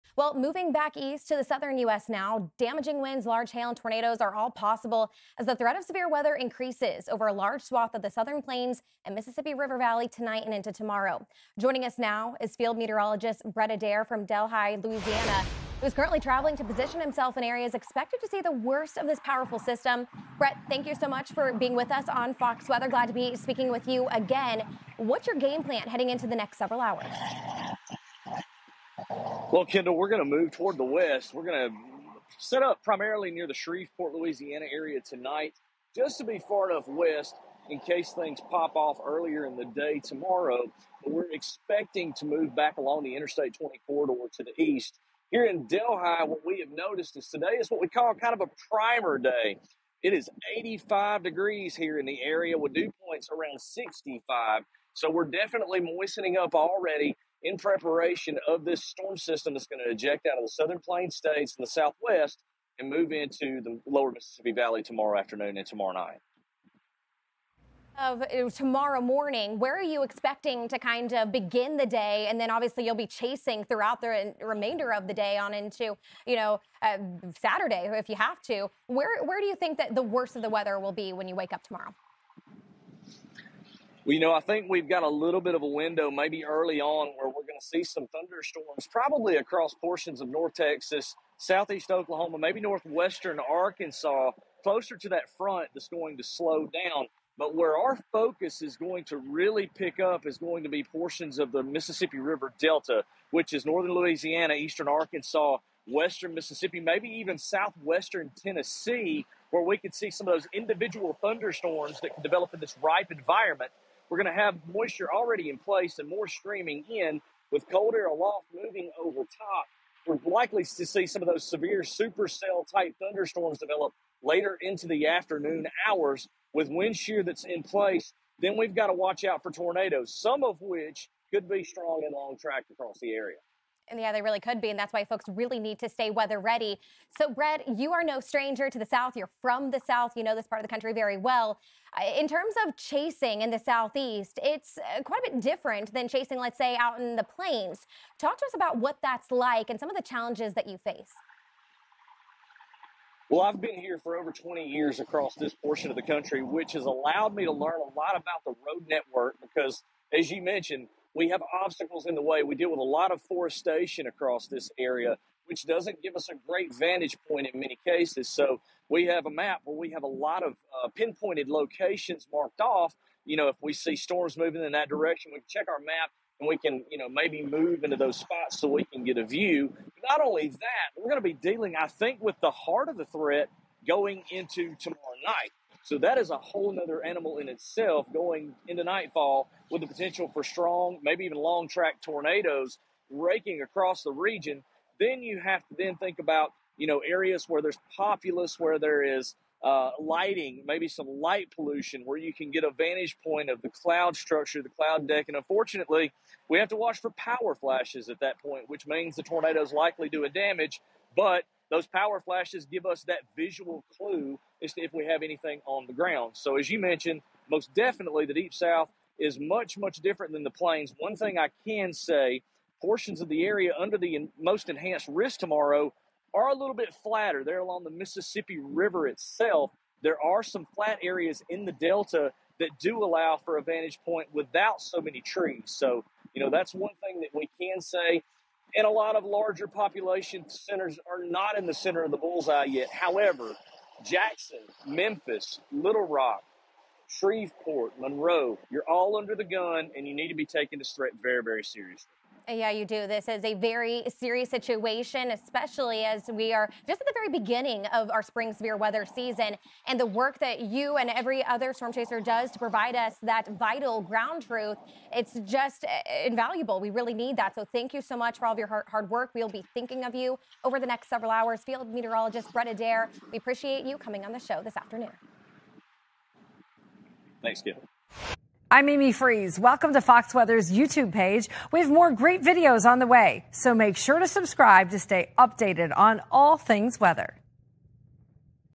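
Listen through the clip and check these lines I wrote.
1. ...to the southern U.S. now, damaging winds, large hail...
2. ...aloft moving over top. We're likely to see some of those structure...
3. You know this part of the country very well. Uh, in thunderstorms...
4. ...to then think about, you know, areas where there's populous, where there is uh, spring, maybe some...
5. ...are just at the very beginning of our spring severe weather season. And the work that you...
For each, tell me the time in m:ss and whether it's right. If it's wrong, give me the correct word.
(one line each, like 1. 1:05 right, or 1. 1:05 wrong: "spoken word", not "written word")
1. 0:01 right
2. 1:58 wrong: "severe", not "structure"
3. 2:20 wrong: "terms", not "thunderstorms"
4. 3:15 wrong: "lighting", not "spring"
5. 4:16 right.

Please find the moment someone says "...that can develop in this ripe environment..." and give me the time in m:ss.
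1:52.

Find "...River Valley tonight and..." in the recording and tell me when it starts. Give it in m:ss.
0:09.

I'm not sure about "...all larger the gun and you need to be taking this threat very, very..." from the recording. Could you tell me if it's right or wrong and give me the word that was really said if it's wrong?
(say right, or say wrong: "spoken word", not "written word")
wrong: "under", not "larger".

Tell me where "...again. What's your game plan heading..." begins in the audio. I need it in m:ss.
0:24.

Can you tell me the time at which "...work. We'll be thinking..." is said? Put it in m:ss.
4:29.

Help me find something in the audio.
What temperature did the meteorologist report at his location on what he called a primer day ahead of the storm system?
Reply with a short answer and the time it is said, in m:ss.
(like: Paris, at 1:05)
85 degrees, at 0:50.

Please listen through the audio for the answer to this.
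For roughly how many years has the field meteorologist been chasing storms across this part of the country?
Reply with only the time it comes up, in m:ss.
2:34.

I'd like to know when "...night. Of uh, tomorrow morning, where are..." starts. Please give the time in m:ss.
1:05.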